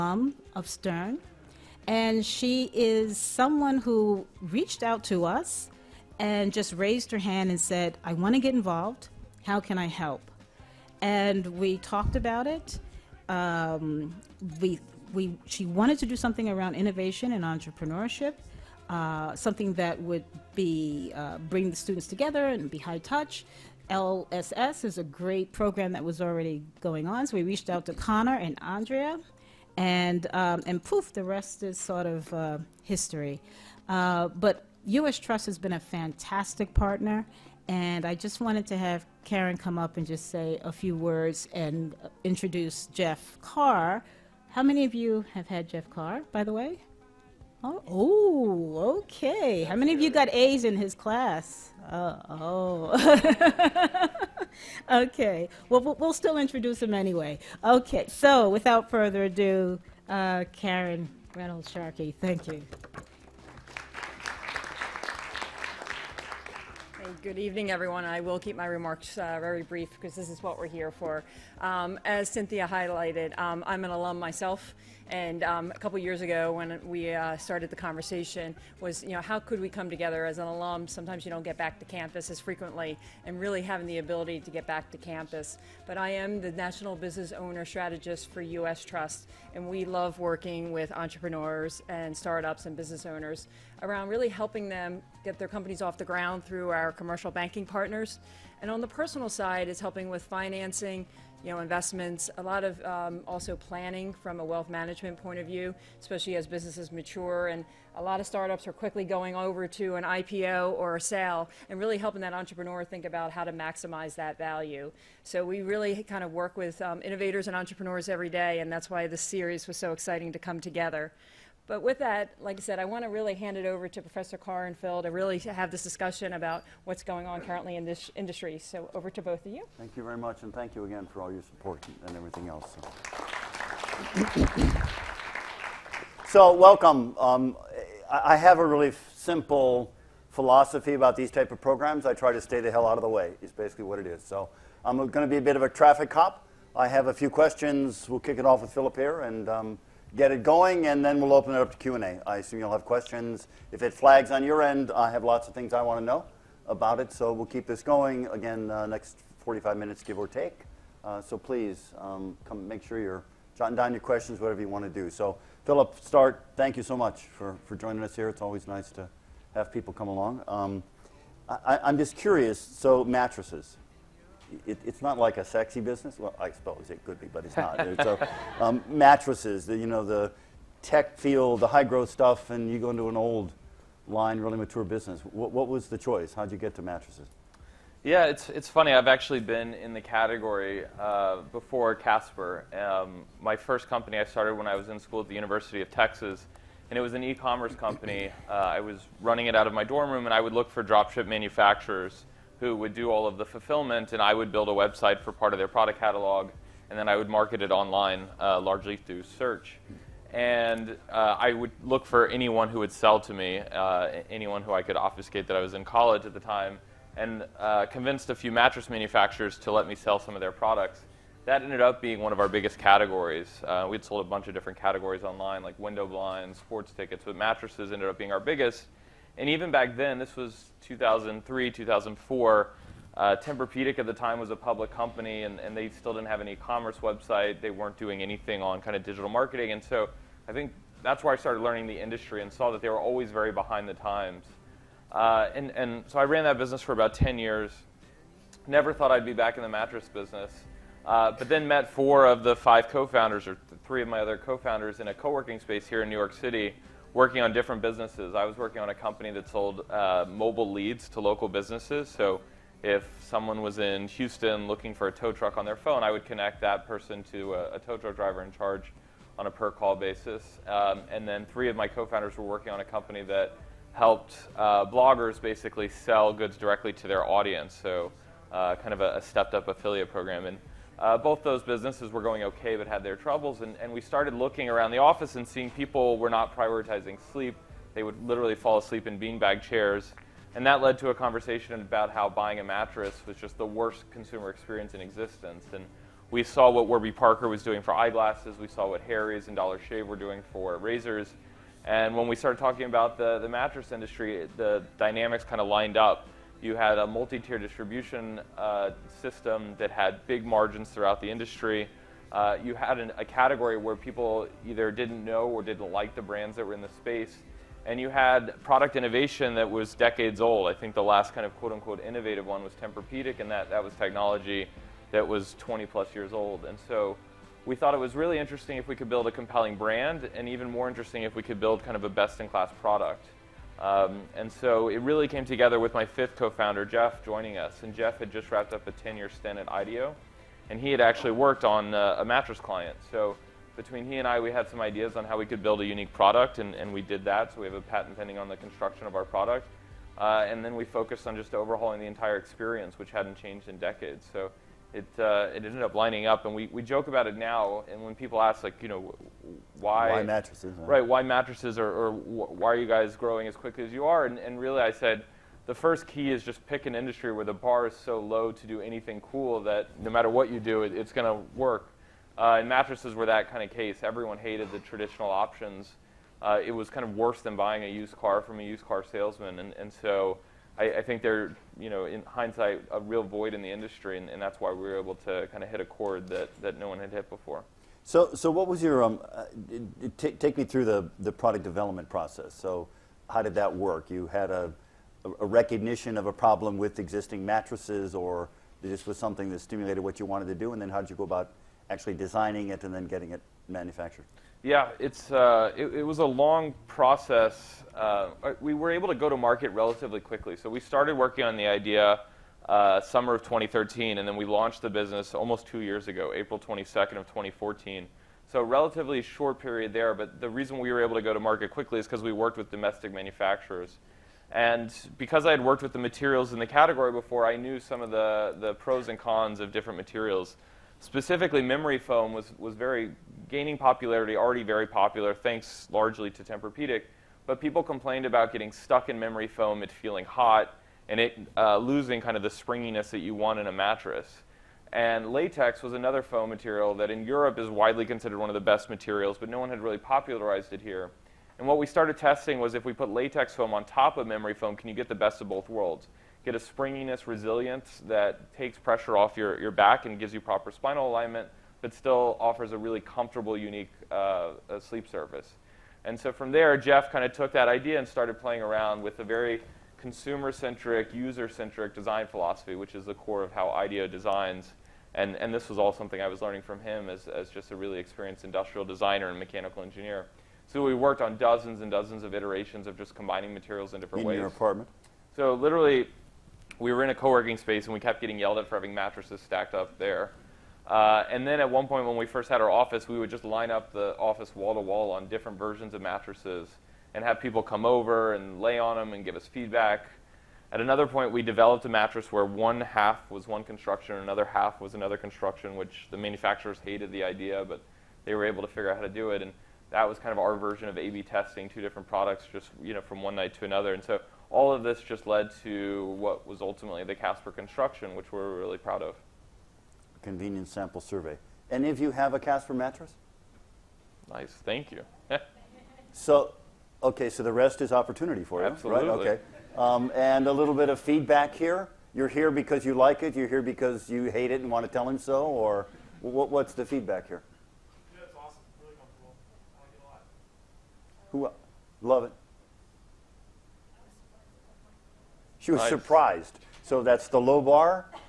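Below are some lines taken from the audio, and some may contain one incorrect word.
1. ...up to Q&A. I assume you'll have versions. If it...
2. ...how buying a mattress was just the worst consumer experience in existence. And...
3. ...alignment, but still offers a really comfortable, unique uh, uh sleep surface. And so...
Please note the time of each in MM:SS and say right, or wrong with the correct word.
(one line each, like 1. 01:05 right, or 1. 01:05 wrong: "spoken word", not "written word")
1. 02:31 wrong: "questions", not "versions"
2. 04:52 right
3. 07:41 right.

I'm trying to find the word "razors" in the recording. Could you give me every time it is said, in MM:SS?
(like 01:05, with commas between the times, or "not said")
05:00.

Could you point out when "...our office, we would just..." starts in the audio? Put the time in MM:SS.
08:12.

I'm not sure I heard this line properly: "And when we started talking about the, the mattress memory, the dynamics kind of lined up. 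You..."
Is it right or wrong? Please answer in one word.
wrong.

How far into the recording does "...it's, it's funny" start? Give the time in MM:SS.
03:08.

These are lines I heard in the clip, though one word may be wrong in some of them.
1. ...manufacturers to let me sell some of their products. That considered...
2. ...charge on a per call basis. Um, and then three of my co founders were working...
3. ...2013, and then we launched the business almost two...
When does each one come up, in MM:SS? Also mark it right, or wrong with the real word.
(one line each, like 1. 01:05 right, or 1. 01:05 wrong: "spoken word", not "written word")
1. 03:38 wrong: "ended", not "considered"
2. 04:28 right
3. 06:53 right.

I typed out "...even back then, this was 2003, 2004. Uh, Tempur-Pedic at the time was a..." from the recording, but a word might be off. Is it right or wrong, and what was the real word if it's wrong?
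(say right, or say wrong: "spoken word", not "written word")
right.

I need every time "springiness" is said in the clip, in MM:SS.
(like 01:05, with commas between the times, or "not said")
07:22, 07:36.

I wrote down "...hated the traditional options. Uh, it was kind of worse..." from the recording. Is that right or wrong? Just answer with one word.
right.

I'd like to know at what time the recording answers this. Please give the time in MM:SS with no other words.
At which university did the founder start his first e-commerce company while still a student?
03:15.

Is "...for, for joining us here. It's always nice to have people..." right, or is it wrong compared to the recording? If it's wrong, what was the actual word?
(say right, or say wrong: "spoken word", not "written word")
right.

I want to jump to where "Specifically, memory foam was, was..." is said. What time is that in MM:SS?
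07:10.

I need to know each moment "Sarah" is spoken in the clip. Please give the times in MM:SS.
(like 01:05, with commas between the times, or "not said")
not said.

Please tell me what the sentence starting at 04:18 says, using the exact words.
I was working on a company that sold uh, mobile leads to local businesses.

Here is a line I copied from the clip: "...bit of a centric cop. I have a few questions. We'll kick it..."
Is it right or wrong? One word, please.
wrong.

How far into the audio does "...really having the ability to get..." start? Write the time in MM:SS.
01:23.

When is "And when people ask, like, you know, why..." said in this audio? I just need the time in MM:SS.
05:57.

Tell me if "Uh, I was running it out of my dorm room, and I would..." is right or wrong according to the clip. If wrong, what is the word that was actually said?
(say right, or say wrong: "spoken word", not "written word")
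right.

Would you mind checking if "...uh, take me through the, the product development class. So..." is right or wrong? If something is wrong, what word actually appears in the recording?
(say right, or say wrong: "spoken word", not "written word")
wrong: "process", not "class".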